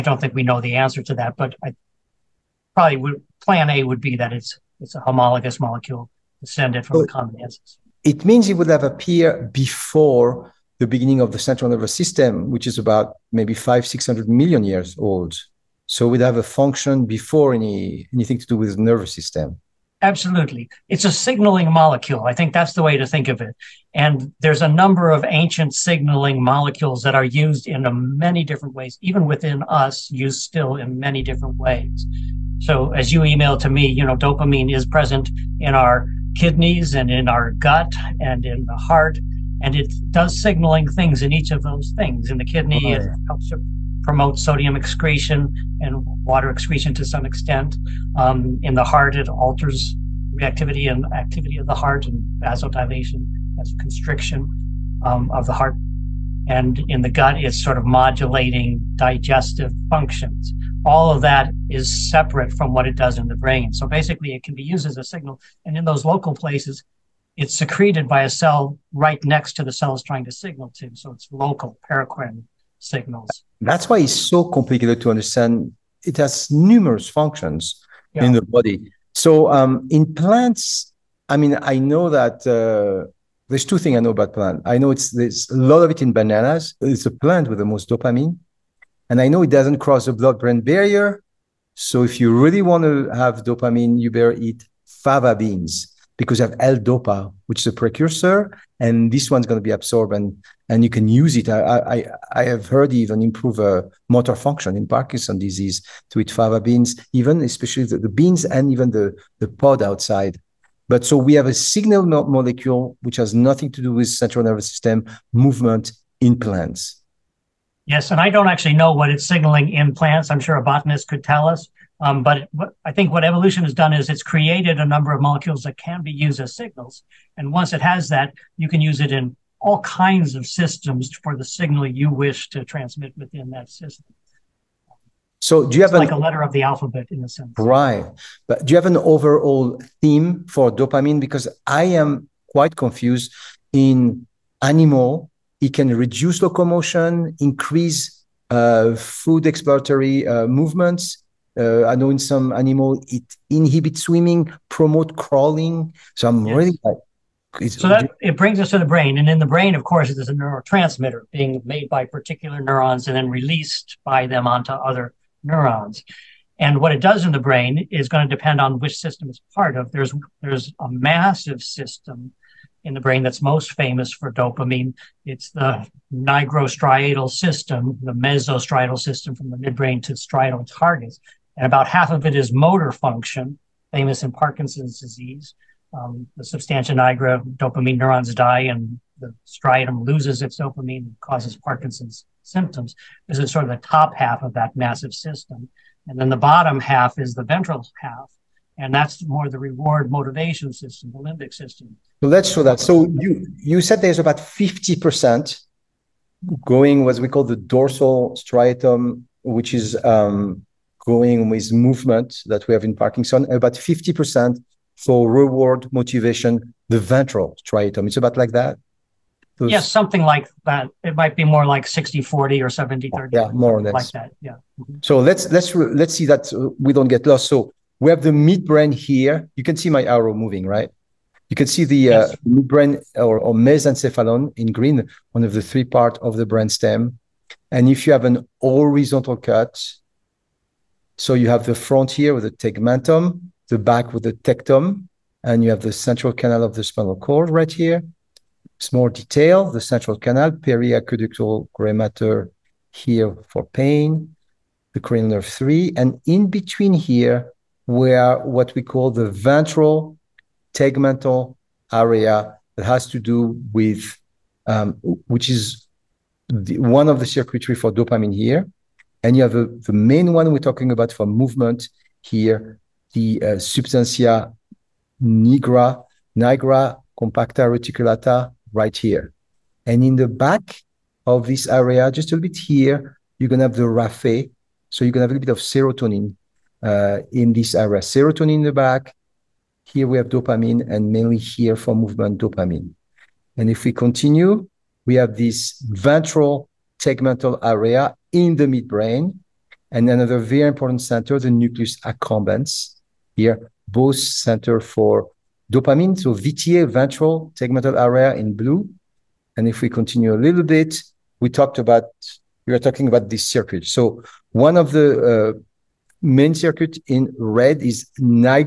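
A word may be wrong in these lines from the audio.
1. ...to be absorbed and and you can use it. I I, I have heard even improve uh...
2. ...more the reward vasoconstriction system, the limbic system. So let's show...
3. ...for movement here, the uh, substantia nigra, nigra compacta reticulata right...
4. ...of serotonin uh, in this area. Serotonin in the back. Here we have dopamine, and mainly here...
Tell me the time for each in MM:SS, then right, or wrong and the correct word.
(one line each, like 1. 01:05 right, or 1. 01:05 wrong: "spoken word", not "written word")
1. 01:39 right
2. 03:19 wrong: "motivation", not "vasoconstriction"
3. 04:31 right
4. 04:45 right.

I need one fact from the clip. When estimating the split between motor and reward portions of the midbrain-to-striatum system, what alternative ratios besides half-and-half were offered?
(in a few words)
60/40 or 70/30.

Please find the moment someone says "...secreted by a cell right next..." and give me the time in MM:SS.
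01:07.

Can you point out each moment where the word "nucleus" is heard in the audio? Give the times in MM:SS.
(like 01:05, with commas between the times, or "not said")
05:01.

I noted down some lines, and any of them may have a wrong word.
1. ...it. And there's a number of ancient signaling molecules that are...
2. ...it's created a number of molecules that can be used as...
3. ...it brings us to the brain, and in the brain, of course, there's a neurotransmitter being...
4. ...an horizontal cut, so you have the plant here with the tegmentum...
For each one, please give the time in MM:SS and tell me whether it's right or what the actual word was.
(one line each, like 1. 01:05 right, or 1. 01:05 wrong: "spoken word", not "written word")
1. 00:23 right
2. 02:04 right
3. 02:38 right
4. 03:58 wrong: "front", not "plant".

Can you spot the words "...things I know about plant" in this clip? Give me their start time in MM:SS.
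01:23.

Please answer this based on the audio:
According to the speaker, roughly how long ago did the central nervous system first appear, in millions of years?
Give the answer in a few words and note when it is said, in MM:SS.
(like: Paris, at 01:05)
500-600 million years, at 00:13.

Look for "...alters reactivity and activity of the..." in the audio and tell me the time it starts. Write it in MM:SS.
00:49.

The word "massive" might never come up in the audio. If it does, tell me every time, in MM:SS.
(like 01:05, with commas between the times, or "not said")
02:50, 03:14.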